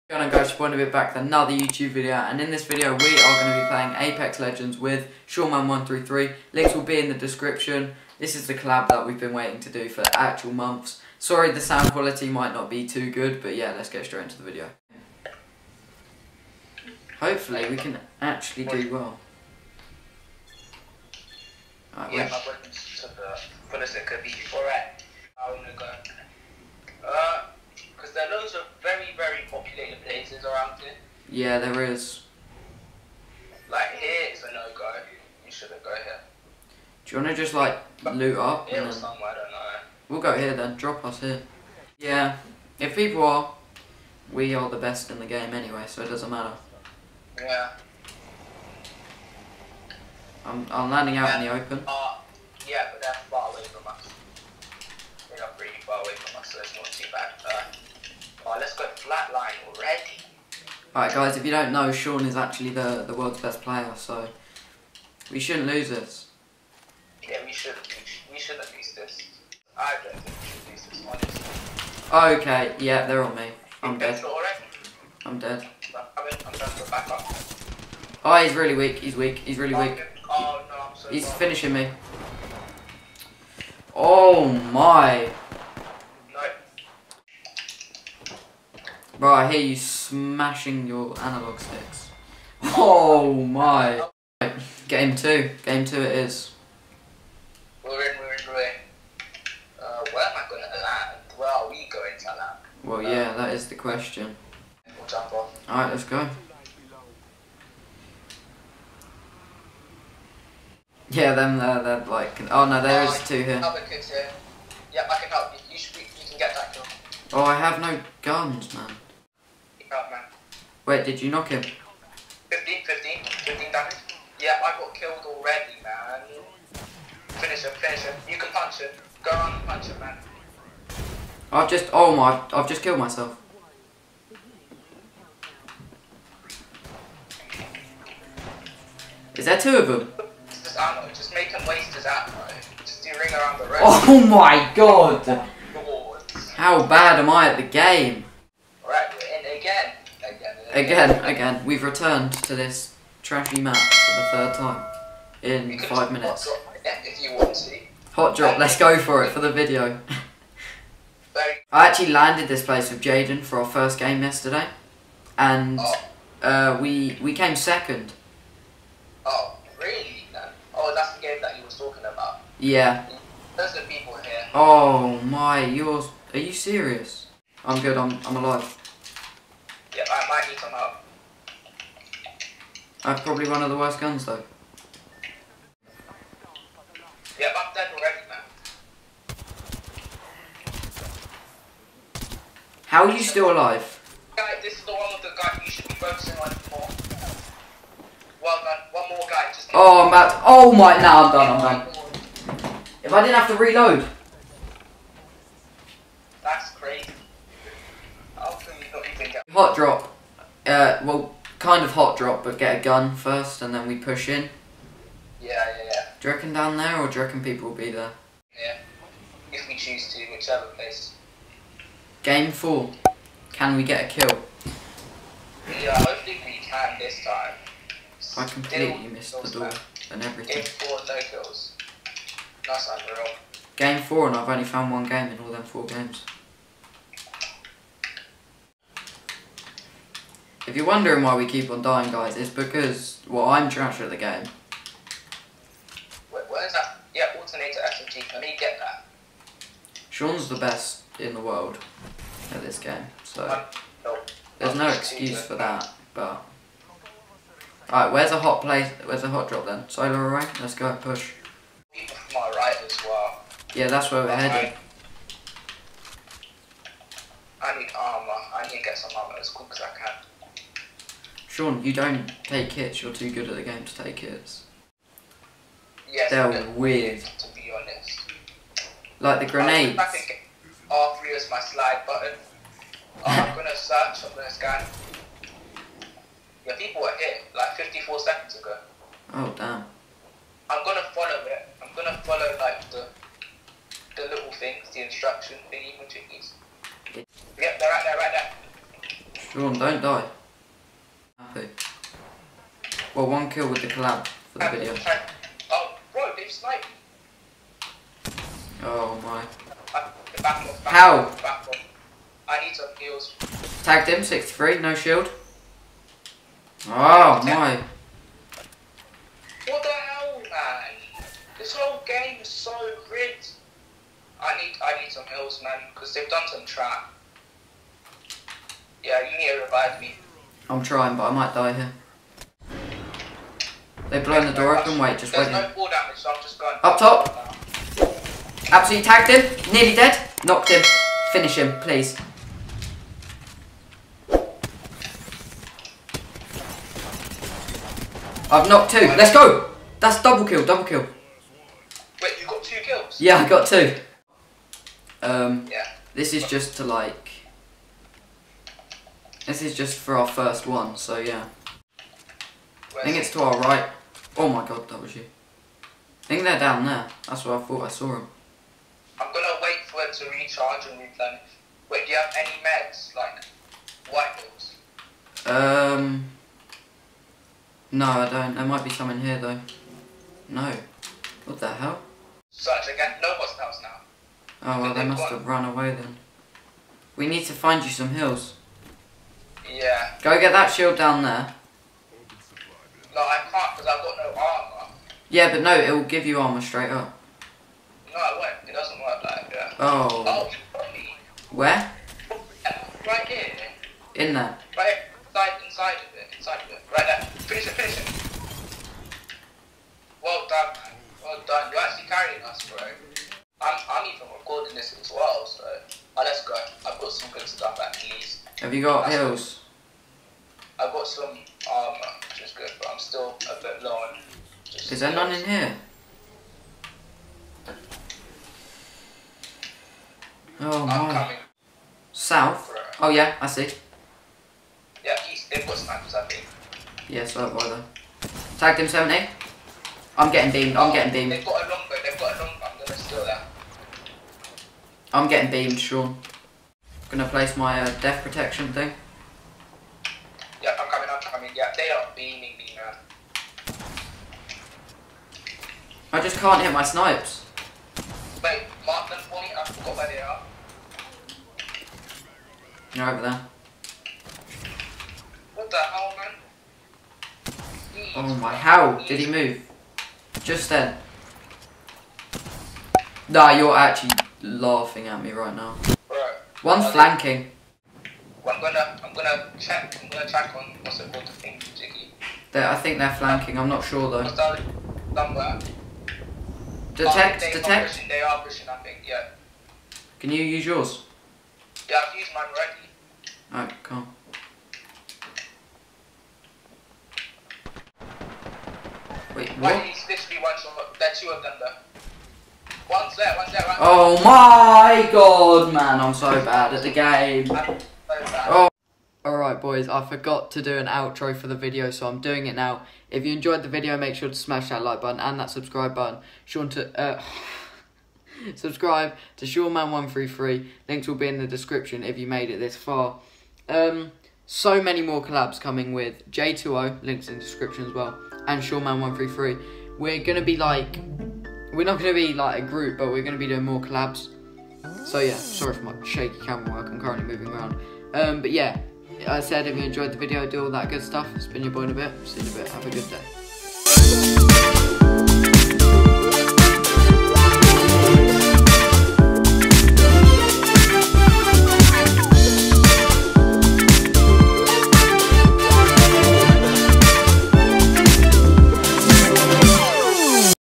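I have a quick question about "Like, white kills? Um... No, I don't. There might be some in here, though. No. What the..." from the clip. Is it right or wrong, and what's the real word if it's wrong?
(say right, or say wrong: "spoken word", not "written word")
wrong: "balls", not "kills".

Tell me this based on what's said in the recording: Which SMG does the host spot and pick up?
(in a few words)
alternator.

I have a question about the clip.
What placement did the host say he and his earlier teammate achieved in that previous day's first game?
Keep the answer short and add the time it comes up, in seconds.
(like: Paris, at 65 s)
second, at 167 s.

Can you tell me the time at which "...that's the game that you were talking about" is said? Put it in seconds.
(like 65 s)
170 s.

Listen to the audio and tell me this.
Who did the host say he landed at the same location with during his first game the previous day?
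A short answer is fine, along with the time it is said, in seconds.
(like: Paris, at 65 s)
Jaden, at 163 s.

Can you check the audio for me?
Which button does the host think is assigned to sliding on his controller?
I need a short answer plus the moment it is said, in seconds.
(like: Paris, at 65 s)
R3, at 280 s.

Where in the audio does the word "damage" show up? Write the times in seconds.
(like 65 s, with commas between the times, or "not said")
123 s, 335 s.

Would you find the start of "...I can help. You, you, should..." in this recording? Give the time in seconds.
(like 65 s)
113 s.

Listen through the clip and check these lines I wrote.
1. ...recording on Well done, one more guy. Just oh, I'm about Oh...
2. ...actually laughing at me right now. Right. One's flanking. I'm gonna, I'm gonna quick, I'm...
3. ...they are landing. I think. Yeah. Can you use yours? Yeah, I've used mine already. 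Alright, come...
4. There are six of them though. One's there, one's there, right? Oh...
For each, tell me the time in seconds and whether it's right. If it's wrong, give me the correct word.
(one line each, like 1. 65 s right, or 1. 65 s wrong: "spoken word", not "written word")
1. 195 s wrong: "focusing", not "recording"
2. 473 s wrong: "check", not "quick"
3. 488 s wrong: "pushing", not "landing"
4. 500 s wrong: "two", not "six".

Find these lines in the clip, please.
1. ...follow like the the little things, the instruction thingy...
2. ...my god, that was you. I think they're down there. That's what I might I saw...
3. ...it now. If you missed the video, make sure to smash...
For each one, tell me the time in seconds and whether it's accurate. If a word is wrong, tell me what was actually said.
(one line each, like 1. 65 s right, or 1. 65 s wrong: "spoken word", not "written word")
1. 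292 s right
2. 364 s wrong: "thought", not "might"
3. 512 s wrong: "enjoyed", not "missed".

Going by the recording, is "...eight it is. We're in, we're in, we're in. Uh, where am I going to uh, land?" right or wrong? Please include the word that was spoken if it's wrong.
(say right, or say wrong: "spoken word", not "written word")
wrong: "two", not "eight".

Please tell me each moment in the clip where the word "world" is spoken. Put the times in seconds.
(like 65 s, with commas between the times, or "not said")
63 s, 251 s.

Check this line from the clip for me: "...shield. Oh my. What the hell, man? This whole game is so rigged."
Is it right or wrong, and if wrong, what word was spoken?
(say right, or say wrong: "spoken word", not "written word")
right.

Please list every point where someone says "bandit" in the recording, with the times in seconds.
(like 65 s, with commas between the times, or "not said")
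not said.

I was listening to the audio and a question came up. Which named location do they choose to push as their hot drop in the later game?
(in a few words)
Solar array.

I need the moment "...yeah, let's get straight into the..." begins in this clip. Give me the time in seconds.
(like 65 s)
13 s.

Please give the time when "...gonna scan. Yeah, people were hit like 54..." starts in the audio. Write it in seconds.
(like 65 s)
284 s.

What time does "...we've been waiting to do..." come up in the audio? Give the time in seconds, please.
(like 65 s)
9 s.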